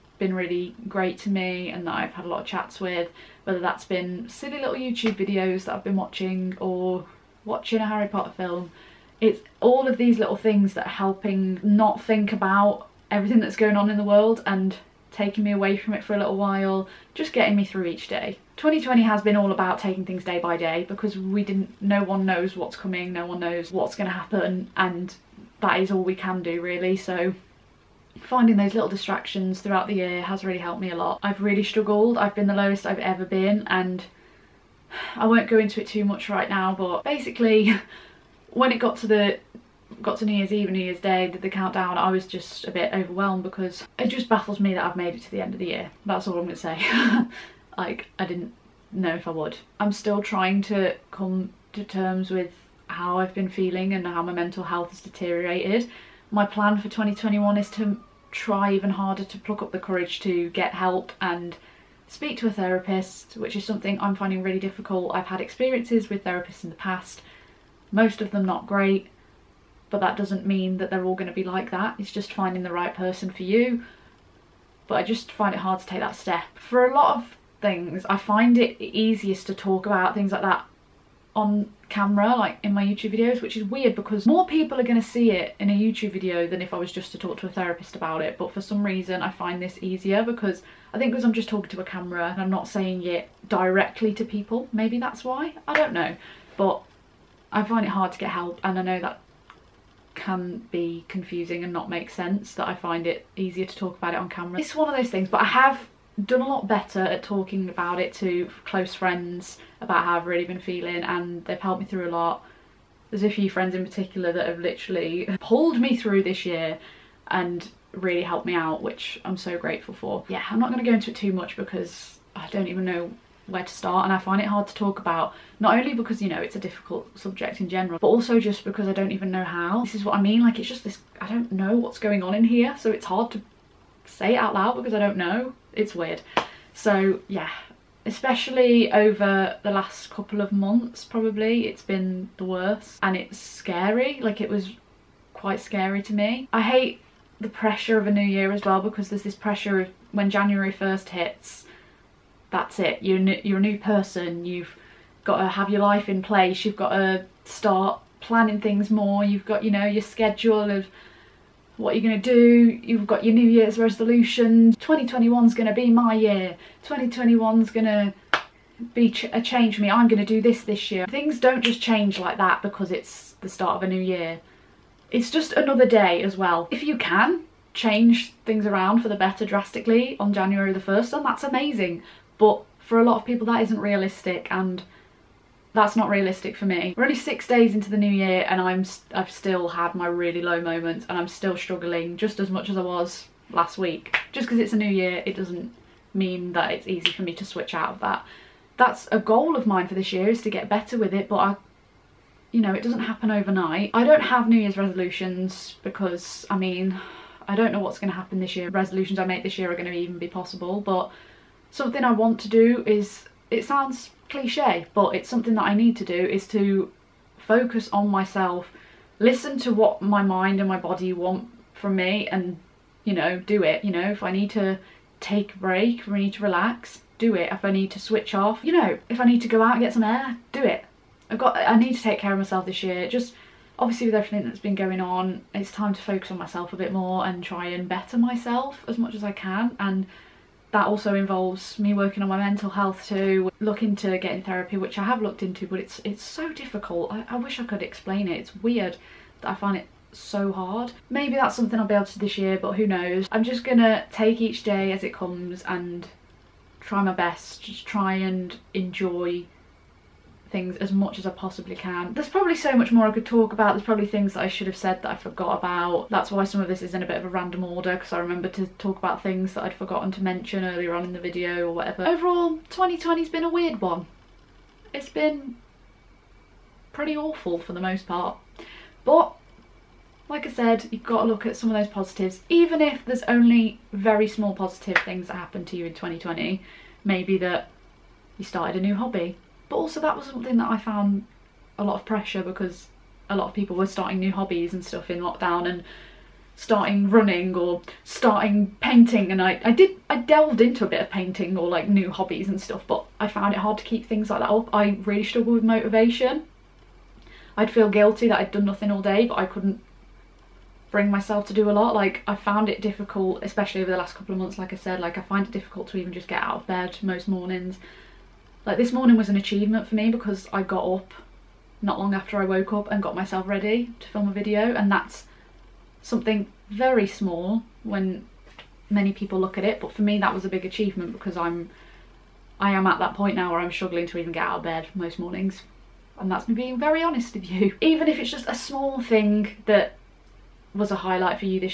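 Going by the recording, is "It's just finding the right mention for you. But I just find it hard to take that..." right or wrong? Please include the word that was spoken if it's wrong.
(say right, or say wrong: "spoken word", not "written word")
wrong: "person", not "mention".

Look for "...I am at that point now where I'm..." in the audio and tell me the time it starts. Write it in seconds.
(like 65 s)
332 s.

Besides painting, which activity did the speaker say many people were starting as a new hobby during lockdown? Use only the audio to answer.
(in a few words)
running.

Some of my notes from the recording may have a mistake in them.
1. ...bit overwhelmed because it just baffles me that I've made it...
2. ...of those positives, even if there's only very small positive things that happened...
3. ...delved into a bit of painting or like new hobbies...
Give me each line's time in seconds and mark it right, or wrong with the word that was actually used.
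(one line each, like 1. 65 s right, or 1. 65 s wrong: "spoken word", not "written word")
1. 42 s right
2. 281 s right
3. 300 s right.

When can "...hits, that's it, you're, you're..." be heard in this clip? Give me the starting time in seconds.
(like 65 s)
151 s.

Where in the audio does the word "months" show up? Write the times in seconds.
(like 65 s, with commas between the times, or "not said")
140 s, 314 s.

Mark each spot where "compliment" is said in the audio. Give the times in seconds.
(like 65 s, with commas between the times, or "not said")
not said.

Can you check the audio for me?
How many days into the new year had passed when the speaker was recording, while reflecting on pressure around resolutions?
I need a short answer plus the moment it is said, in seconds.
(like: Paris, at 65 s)
6, at 187 s.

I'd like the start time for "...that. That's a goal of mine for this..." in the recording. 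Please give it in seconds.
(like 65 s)
197 s.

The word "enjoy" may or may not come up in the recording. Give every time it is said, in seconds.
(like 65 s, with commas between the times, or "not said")
258 s.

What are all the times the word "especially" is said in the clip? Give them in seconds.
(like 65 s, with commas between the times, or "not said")
138 s, 313 s.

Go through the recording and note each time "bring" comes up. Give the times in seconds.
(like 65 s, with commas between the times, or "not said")
310 s.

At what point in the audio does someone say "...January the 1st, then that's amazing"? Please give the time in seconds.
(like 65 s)
180 s.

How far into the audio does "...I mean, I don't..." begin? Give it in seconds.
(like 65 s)
206 s.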